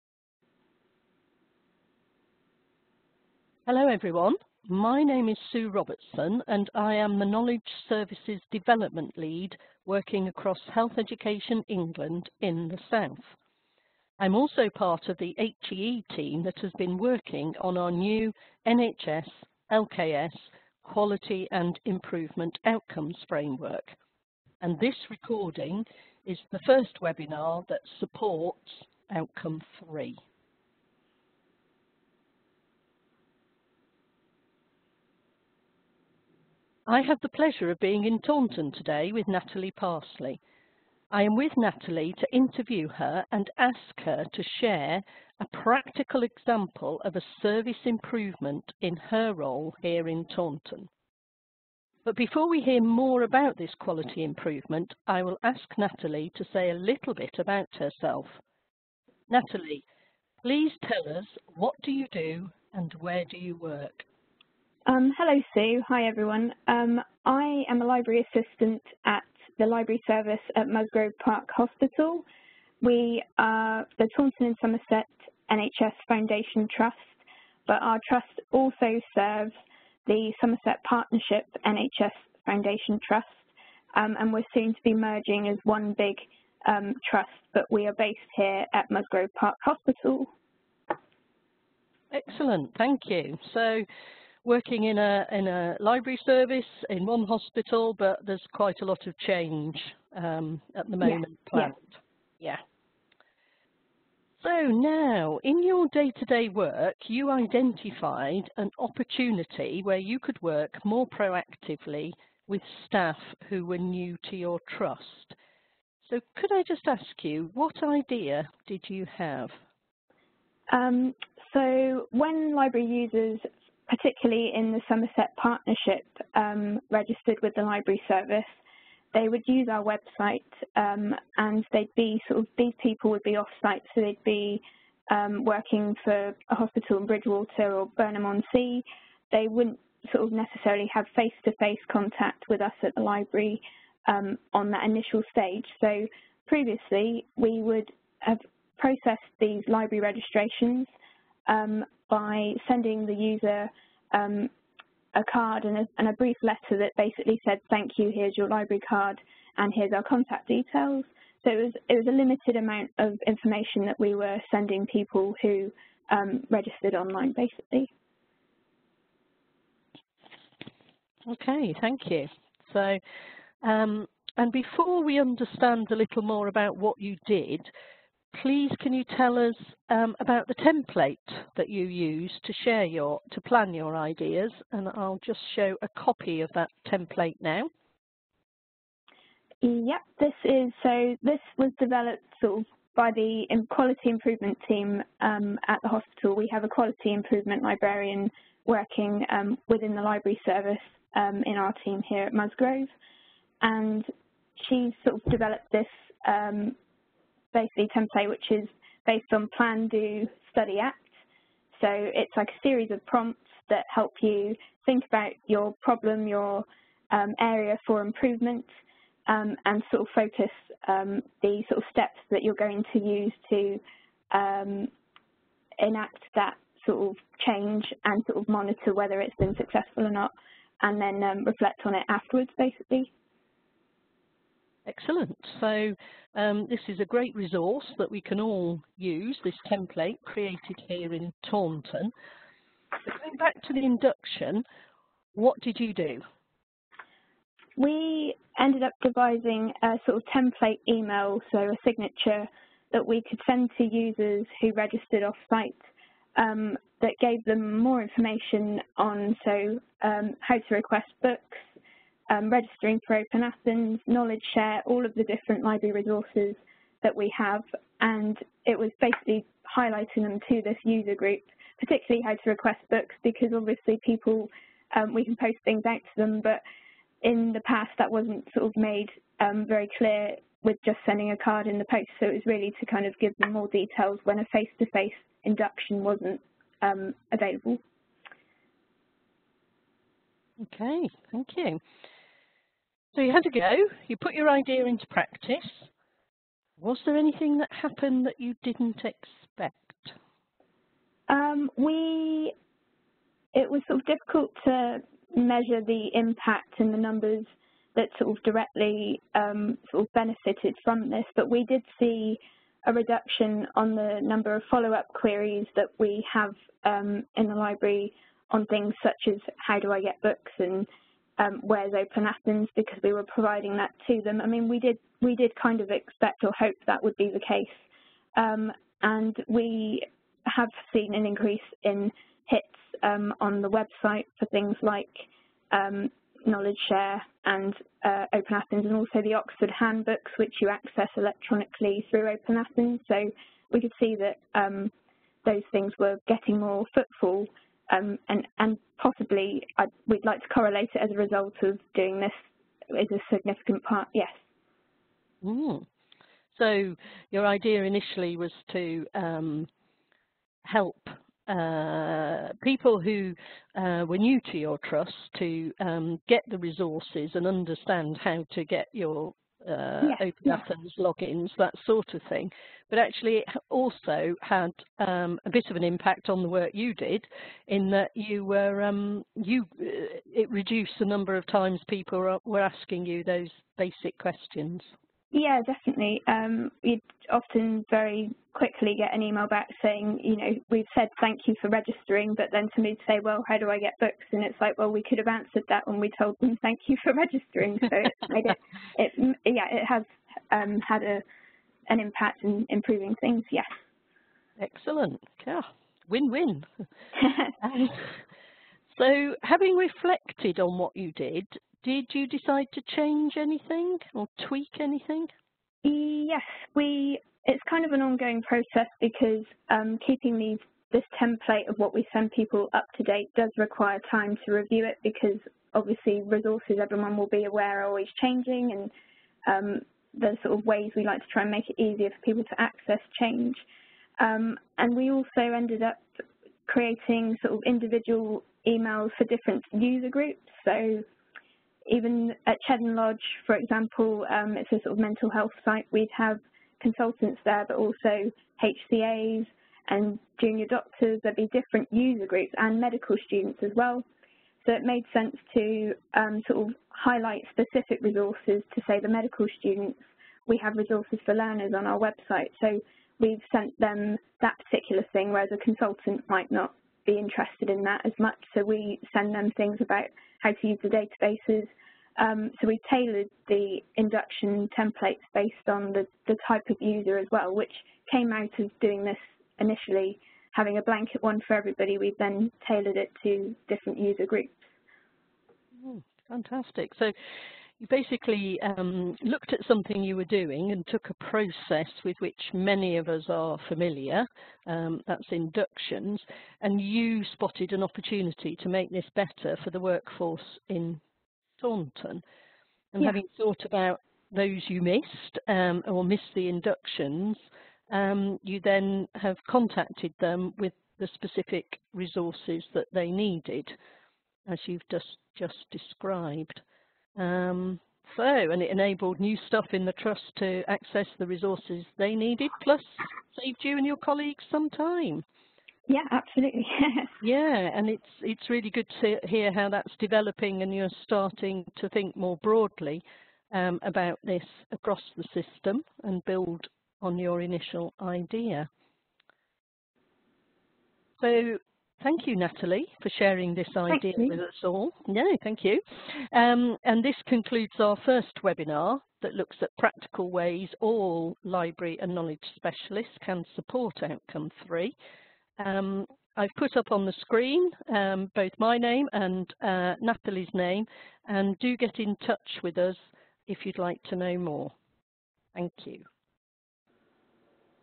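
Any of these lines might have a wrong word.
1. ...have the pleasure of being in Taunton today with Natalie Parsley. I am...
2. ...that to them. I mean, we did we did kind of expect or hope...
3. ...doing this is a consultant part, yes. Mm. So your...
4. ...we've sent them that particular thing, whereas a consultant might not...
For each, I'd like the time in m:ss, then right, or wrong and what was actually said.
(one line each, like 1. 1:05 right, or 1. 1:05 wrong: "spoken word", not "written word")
1. 0:37 right
2. 5:23 right
3. 5:51 wrong: "significant", not "consultant"
4. 7:43 right.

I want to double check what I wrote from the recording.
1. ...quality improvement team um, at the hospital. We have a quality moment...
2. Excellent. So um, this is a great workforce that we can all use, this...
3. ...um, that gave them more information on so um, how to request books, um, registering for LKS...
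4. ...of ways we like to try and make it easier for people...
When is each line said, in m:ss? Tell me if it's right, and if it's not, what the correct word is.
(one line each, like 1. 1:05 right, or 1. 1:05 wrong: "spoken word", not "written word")
1. 3:13 wrong: "improvement", not "moment"
2. 3:54 wrong: "resource", not "workforce"
3. 4:16 wrong: "Open", not "LKS"
4. 7:10 right.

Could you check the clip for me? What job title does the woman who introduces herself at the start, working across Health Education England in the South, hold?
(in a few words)
Knowledge Services Development Lead.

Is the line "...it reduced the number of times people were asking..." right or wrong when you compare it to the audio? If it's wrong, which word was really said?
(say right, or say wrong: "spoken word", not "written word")
right.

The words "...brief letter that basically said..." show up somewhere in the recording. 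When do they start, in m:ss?
2:36.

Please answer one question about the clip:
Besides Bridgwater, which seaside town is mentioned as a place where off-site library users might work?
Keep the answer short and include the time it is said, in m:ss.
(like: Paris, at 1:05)
Burnham-on-Sea, at 2:17.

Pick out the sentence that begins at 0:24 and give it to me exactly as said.
And this recording is the first webinar that supports Outcome 3.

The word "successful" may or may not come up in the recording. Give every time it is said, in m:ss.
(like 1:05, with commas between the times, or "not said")
3:49.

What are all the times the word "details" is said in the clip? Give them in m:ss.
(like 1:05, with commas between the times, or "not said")
2:40, 4:43.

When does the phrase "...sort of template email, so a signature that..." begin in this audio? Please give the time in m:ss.
4:10.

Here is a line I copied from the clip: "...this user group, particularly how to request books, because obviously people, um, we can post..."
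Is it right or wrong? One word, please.
right.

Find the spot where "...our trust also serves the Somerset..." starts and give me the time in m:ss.
1:17.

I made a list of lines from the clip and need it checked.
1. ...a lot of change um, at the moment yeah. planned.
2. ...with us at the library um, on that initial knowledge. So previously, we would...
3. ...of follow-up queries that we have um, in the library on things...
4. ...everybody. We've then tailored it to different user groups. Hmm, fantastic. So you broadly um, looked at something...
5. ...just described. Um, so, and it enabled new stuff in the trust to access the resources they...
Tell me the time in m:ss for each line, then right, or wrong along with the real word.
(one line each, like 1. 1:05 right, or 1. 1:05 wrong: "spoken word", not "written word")
1. 1:38 right
2. 2:22 wrong: "stage", not "knowledge"
3. 5:14 right
4. 8:01 wrong: "basically", not "broadly"
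5. 8:35 right.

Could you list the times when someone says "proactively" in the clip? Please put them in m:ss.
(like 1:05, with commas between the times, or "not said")
1:51.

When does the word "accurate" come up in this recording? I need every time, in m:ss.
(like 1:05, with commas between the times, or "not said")
not said.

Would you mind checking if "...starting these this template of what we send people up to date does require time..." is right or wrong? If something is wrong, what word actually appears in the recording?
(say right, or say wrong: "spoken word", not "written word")
wrong: "keeping", not "starting".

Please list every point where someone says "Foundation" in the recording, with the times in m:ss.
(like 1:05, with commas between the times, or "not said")
1:16, 1:22.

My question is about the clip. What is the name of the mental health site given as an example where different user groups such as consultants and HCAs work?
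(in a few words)
Cheddon Lodge.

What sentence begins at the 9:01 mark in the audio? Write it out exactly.
So Thank you, Natalie, for sharing this idea with us all.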